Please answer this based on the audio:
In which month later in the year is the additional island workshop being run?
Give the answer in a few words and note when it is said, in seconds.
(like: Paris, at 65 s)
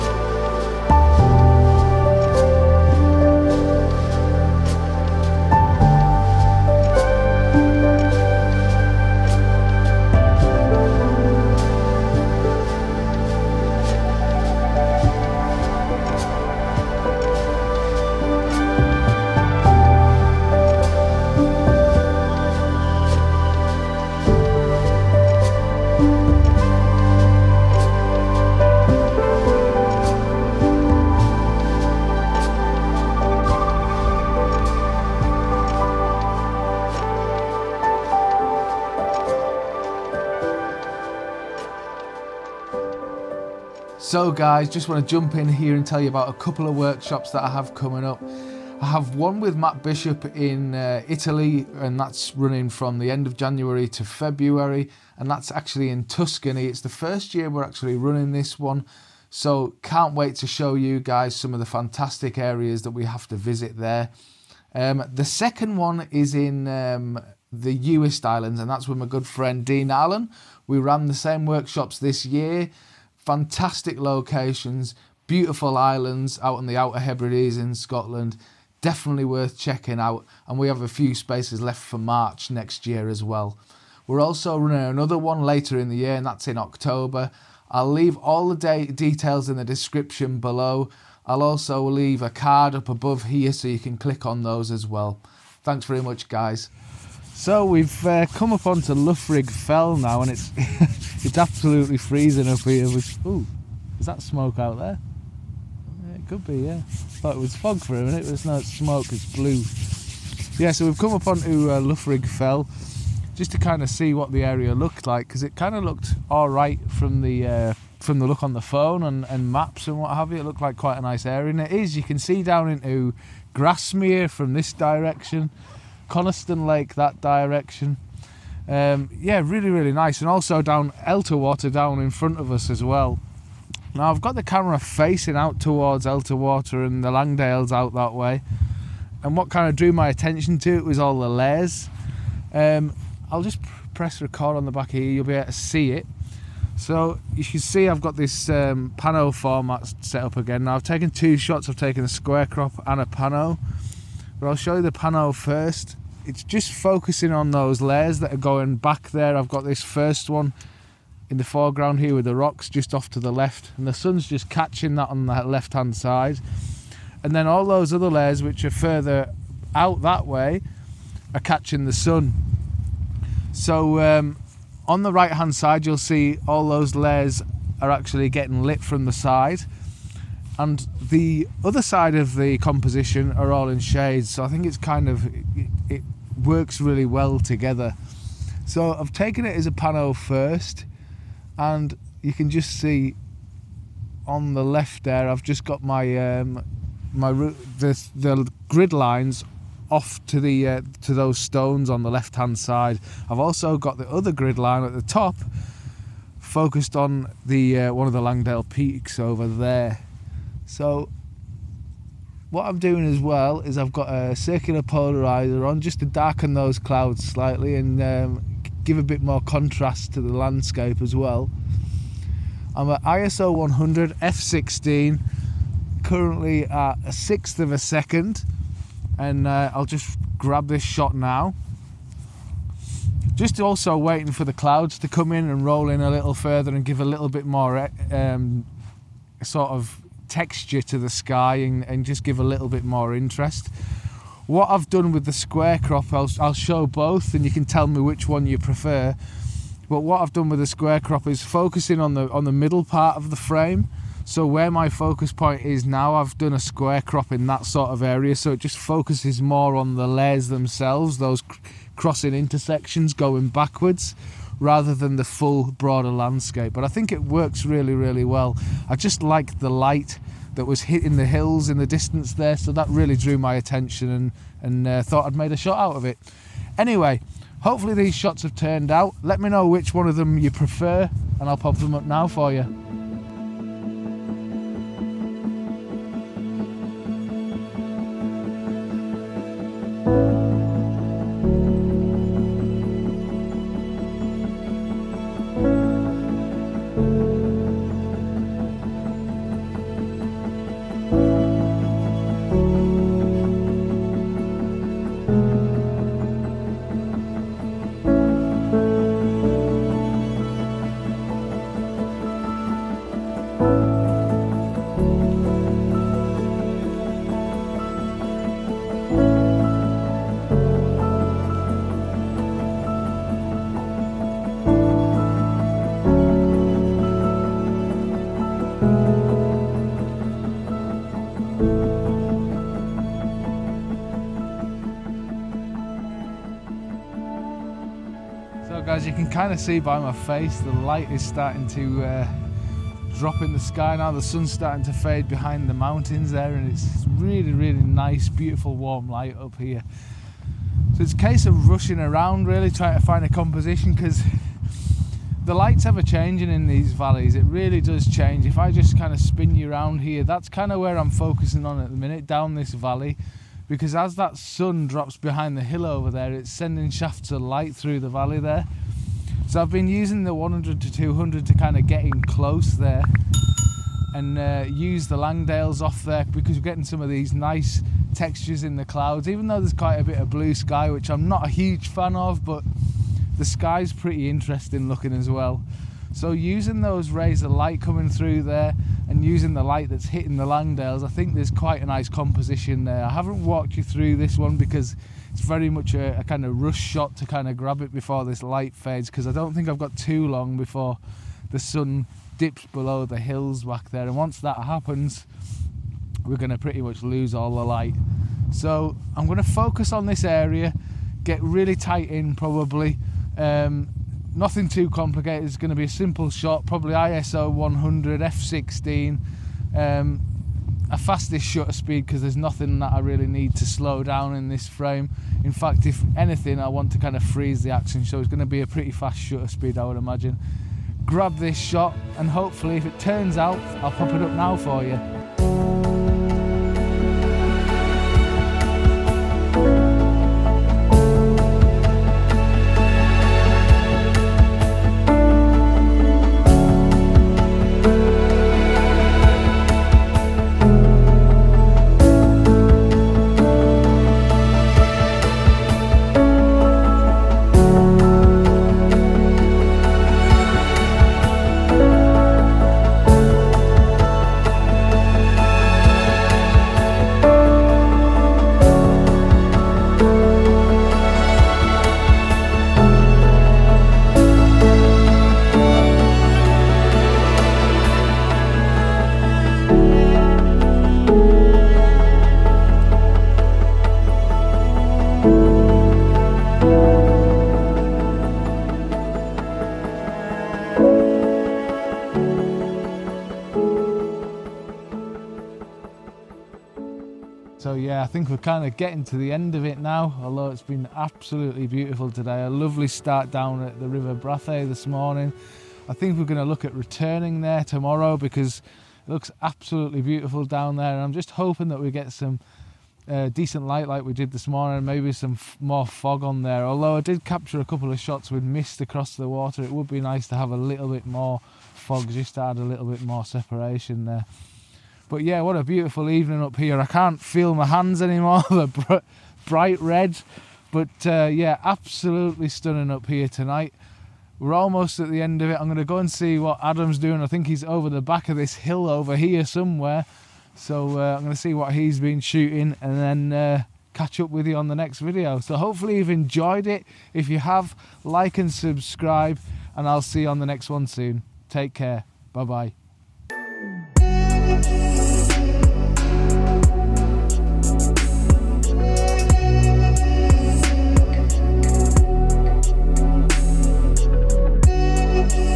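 October, at 86 s.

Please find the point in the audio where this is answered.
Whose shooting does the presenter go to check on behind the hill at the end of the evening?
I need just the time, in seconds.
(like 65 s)
536 s.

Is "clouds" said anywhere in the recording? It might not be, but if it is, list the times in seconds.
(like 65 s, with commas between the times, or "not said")
216 s, 234 s, 378 s.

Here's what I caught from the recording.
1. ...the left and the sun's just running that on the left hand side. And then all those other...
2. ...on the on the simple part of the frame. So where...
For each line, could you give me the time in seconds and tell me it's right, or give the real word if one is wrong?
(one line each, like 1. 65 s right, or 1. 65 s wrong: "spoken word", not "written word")
1. 163 s wrong: "catching", not "running"
2. 252 s wrong: "middle", not "simple".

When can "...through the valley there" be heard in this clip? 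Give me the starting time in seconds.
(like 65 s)
367 s.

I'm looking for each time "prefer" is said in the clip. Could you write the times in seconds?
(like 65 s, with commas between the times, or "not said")
248 s, 280 s.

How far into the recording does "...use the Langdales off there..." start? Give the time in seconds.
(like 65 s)
374 s.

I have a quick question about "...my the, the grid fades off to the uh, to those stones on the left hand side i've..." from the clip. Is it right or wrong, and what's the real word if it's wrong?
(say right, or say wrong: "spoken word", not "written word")
wrong: "lines", not "fades".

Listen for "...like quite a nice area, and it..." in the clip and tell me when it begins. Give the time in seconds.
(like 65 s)
120 s.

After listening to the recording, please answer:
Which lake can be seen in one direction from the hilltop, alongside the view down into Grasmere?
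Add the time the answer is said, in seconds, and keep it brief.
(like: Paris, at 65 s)
Coniston, at 126 s.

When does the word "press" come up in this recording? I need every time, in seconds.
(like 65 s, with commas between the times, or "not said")
143 s.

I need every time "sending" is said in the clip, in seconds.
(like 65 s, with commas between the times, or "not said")
366 s.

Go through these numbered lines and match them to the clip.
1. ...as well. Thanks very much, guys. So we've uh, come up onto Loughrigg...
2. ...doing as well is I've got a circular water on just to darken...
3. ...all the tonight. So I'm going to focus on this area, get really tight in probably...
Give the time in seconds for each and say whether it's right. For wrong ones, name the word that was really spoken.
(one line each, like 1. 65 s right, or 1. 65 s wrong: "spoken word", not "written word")
1. 94 s right
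2. 212 s wrong: "polarizer", not "water"
3. 407 s wrong: "light", not "tonight".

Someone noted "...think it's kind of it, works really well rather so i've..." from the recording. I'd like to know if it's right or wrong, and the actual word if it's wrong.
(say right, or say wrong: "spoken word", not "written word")
wrong: "together", not "rather".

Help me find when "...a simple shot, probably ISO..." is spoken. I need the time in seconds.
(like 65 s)
415 s.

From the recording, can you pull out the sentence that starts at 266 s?
But I think it works really, really well.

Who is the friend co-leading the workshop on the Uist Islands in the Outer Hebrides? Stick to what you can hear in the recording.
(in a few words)
Dean Allen.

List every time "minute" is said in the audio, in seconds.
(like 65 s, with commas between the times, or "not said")
108 s, 361 s.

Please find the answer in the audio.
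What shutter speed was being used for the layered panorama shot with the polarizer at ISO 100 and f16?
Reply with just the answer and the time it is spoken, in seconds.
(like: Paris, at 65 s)
1/6 second, at 227 s.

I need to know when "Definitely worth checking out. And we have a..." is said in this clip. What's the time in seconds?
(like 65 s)
78 s.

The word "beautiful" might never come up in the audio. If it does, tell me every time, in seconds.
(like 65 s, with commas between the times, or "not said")
75 s, 348 s, 501 s, 510 s, 525 s.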